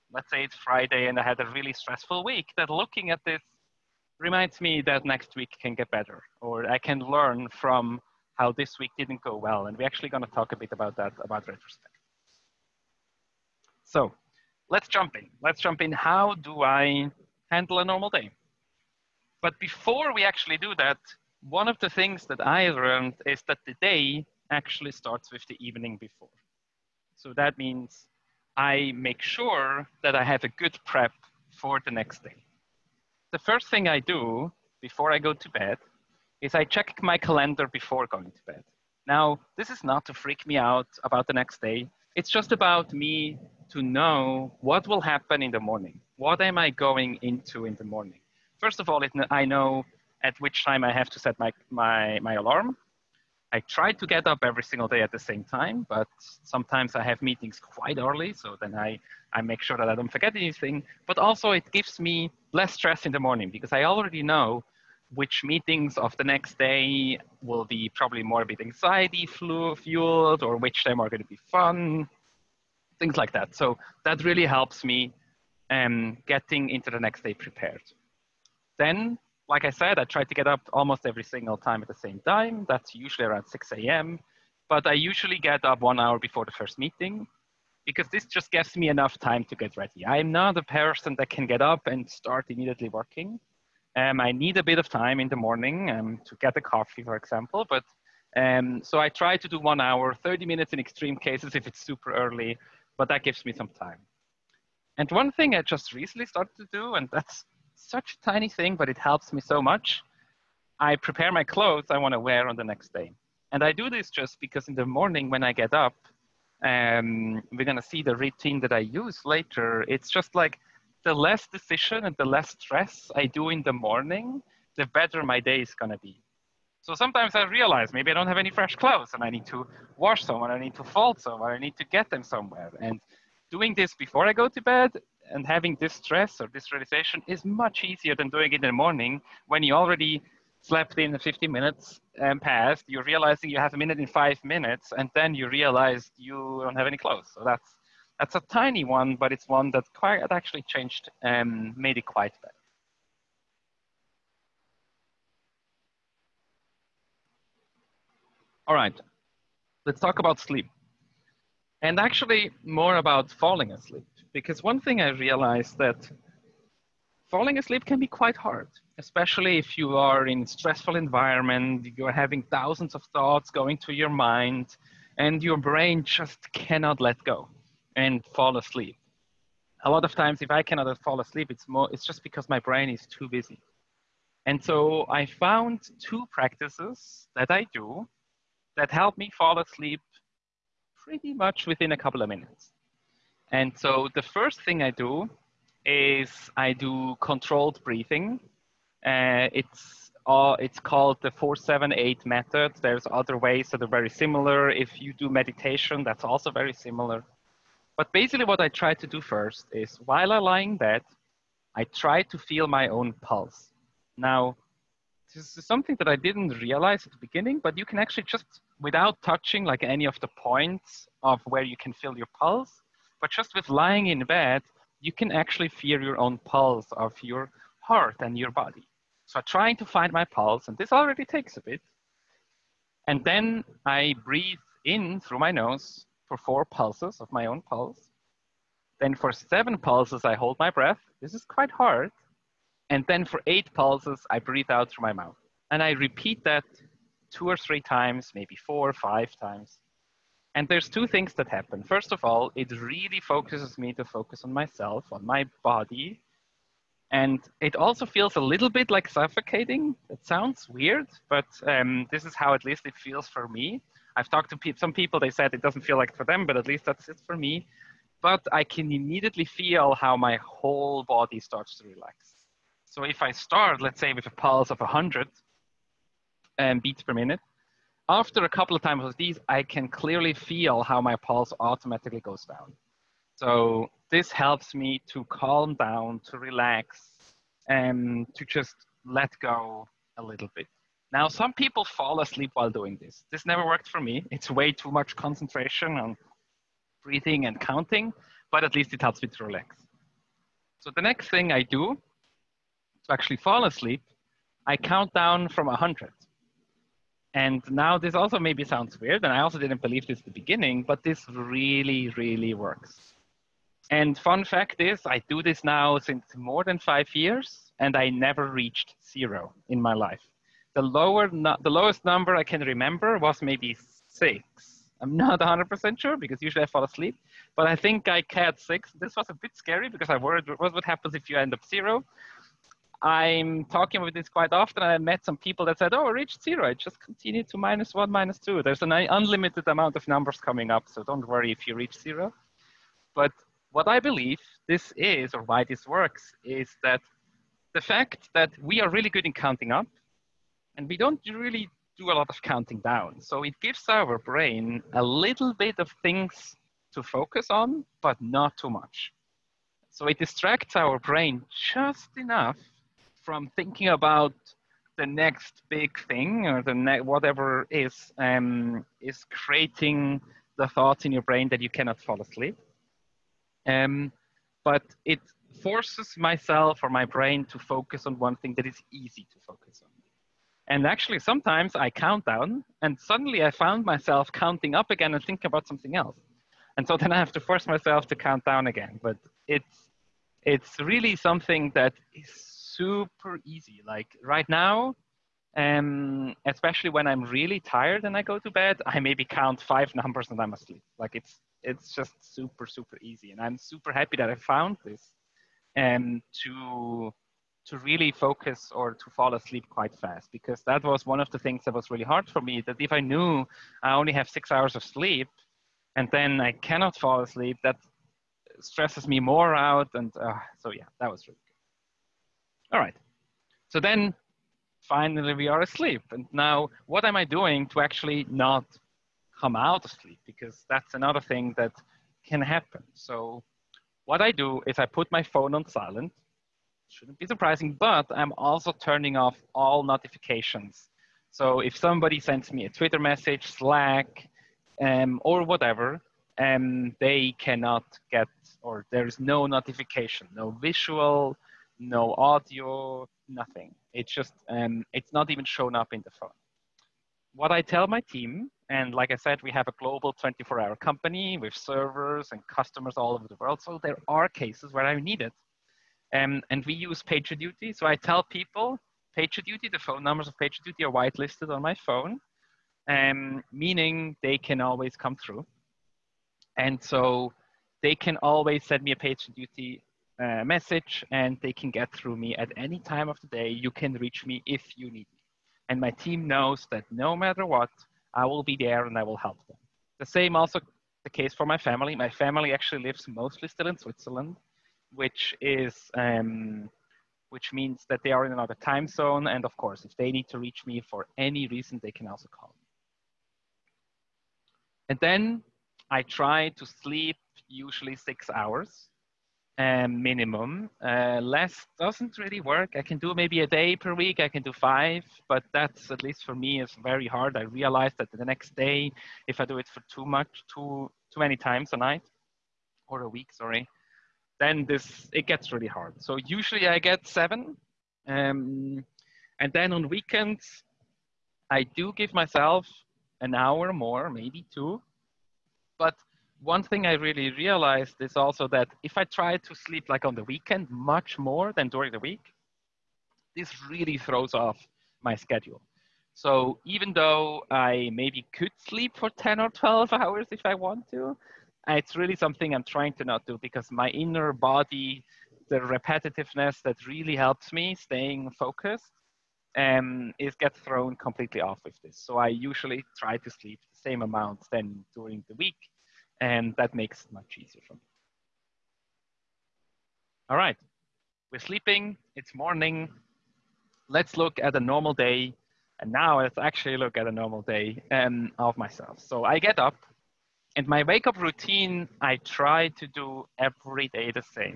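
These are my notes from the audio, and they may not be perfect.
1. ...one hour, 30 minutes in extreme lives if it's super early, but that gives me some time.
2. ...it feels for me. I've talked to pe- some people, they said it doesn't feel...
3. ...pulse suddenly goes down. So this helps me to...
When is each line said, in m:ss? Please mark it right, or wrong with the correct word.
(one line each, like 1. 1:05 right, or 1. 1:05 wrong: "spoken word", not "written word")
1. 1:39 wrong: "cases", not "lives"
2. 4:22 right
3. 4:41 wrong: "automatically", not "suddenly".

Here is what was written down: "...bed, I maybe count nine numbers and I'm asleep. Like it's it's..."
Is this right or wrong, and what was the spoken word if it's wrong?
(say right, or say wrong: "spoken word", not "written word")
wrong: "five", not "nine".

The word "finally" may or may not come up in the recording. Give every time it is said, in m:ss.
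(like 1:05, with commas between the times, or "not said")
7:04.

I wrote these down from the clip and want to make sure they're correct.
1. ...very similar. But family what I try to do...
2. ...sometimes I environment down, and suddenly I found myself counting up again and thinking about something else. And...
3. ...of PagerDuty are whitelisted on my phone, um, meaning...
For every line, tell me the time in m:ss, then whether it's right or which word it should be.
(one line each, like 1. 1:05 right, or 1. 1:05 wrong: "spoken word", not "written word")
1. 3:26 wrong: "basically", not "family"
2. 6:21 wrong: "count", not "environment"
3. 7:50 right.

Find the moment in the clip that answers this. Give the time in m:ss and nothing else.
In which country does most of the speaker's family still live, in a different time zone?
8:13.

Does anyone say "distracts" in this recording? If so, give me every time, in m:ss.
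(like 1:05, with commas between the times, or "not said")
6:00.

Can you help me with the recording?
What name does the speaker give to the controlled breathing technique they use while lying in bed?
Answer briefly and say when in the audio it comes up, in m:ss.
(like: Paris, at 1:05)
478 method, at 3:21.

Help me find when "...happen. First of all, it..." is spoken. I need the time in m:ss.
4:11.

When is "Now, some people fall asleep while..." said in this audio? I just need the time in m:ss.
4:51.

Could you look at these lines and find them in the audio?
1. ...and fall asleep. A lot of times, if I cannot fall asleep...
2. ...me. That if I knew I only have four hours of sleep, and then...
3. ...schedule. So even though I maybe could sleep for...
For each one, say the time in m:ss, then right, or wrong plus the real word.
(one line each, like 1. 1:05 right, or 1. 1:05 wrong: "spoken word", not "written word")
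1. 2:57 right
2. 6:52 wrong: "six", not "four"
3. 9:05 right.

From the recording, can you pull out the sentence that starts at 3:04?
And so I found two practices that I do that help me fall asleep pretty much within a couple of minutes.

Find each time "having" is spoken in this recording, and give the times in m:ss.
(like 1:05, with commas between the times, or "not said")
2:15, 2:52.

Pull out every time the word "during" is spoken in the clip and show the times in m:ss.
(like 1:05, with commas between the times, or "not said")
9:01, 9:24.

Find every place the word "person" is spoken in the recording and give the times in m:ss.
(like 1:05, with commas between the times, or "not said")
1:30.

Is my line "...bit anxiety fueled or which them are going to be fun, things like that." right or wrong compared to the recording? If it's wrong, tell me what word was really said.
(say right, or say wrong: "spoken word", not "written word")
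right.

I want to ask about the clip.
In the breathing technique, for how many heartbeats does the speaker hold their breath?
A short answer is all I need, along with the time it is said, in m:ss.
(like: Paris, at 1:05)
7, at 3:59.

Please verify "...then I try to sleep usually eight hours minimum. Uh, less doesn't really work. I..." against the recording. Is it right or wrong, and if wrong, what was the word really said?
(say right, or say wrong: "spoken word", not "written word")
wrong: "six", not "eight".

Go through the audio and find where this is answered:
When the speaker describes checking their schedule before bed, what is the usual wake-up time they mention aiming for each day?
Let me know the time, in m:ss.
1:23.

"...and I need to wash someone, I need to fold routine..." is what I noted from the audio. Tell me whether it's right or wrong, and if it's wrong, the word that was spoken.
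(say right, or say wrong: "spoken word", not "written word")
wrong: "someone", not "routine".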